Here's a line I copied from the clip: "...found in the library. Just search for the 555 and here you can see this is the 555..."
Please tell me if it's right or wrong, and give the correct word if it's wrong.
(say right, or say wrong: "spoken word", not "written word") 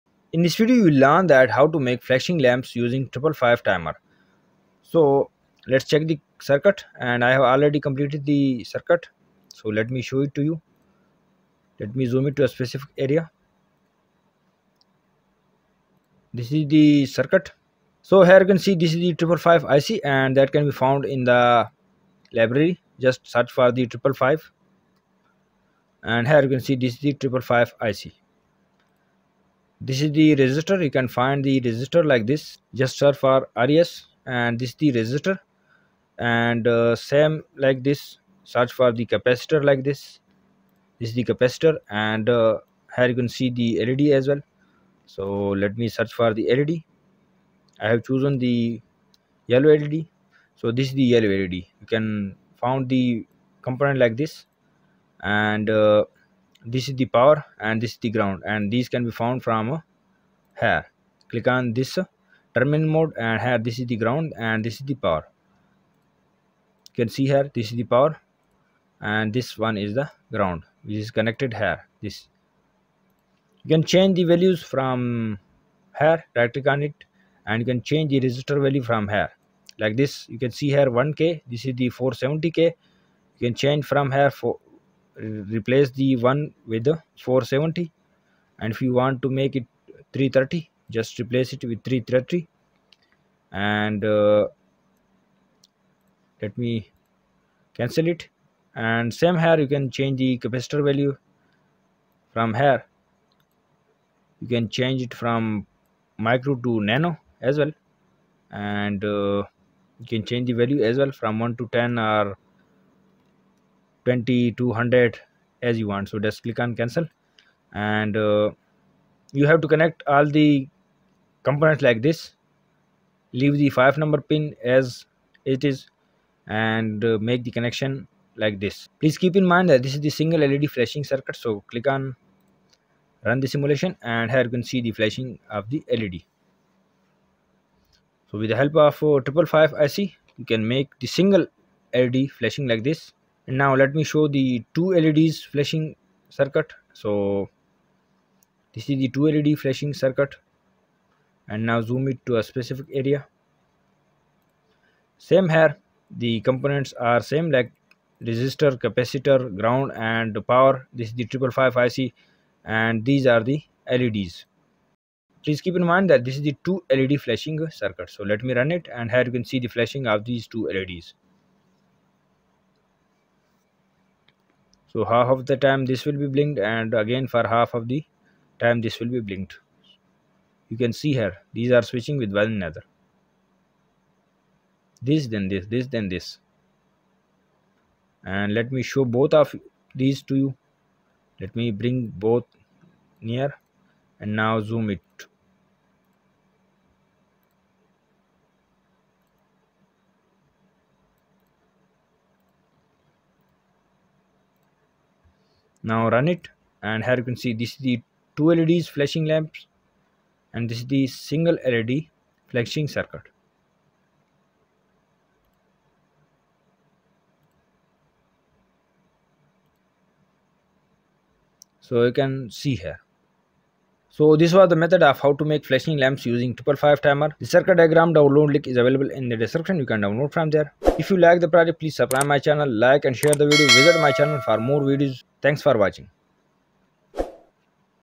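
right.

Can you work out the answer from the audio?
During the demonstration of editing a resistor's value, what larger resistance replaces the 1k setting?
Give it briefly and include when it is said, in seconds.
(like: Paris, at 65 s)
470k, at 81 s.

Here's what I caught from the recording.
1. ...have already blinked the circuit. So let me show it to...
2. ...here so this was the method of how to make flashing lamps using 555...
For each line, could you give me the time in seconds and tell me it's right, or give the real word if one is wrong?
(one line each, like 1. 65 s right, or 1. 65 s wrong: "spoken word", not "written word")
1. 7 s wrong: "completed", not "blinked"
2. 222 s right.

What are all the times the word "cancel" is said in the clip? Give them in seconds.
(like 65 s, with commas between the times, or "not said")
97 s, 116 s.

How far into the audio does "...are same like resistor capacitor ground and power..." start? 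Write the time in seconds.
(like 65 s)
156 s.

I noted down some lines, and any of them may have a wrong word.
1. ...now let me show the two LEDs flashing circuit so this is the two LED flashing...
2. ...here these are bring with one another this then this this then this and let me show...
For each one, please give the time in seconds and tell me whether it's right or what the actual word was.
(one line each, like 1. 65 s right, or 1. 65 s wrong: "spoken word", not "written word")
1. 143 s right
2. 181 s wrong: "switching", not "bring".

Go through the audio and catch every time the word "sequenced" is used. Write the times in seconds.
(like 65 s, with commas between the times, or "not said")
not said.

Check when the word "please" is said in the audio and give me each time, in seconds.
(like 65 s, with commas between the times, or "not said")
128 s, 165 s, 231 s.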